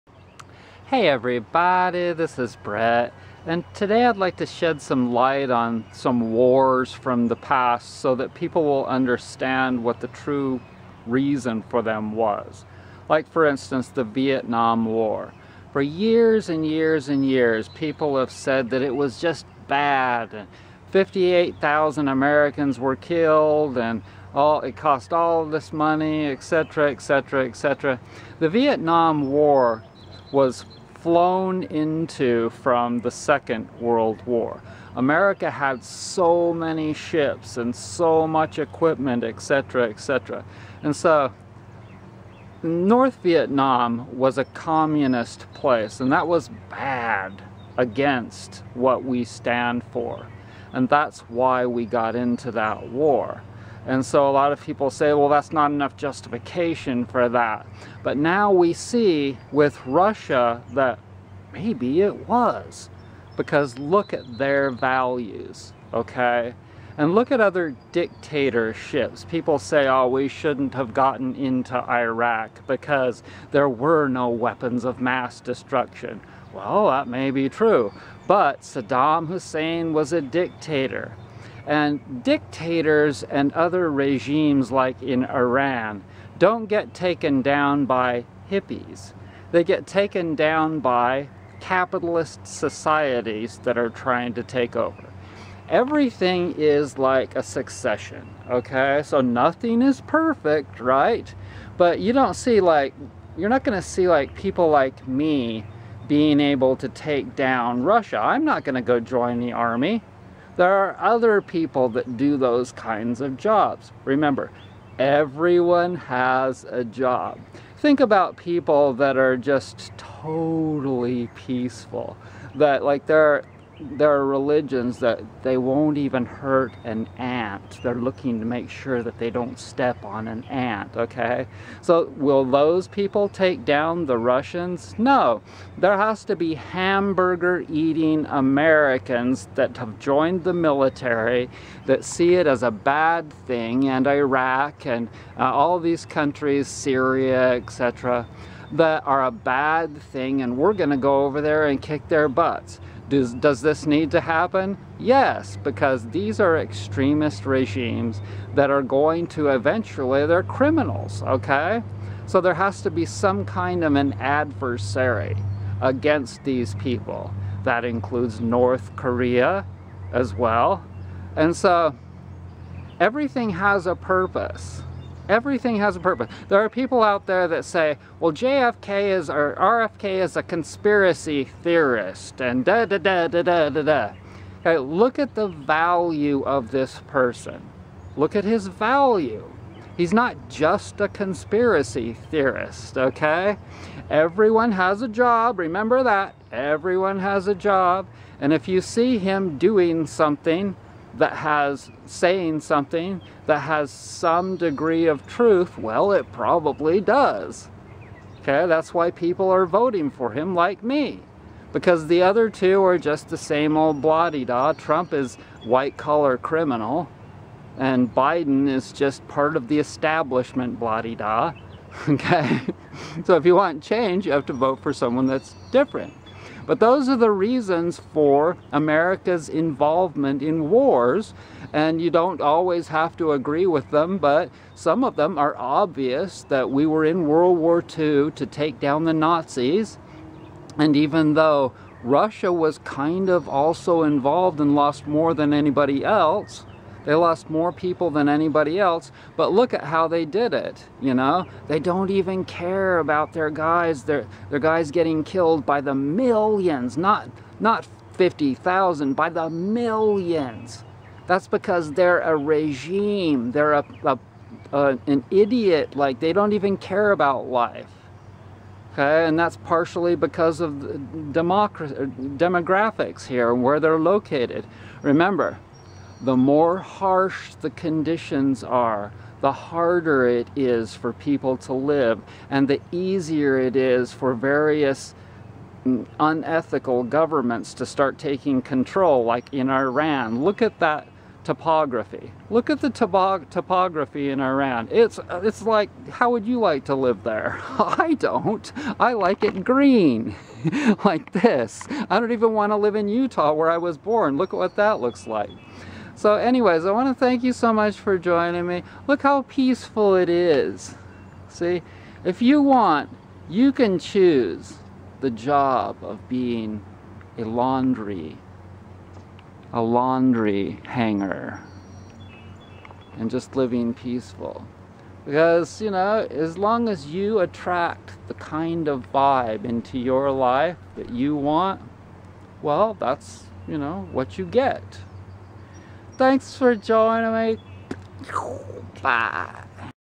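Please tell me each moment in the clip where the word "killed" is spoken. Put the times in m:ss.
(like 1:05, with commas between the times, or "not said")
0:22, 4:15.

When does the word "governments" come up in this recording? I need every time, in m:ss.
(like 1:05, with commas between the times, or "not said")
4:47.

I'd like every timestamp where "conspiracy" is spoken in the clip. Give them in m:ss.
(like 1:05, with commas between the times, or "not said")
3:00, 3:11.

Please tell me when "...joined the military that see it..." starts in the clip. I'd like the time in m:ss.
2:19.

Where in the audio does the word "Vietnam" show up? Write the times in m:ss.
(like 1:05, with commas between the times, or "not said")
0:14, 0:28, 0:43.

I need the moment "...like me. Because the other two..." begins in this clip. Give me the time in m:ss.
3:30.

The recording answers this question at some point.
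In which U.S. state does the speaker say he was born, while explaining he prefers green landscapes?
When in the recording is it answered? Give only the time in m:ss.
5:03.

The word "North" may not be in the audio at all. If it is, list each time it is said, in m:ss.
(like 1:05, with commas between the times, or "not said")
0:42, 2:48.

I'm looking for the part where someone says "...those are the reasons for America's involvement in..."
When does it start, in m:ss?
3:46.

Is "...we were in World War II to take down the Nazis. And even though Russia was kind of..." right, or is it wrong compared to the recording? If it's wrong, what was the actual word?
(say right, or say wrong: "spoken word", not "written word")
right.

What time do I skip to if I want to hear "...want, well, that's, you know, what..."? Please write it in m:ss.
5:31.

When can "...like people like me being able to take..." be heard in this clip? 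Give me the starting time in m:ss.
1:44.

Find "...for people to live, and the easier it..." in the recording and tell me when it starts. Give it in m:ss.
4:40.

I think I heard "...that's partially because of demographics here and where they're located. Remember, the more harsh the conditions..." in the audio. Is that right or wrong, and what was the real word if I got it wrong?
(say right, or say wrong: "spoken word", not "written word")
right.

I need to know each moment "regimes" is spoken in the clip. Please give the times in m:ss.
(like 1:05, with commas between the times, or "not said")
1:23, 2:37, 4:22.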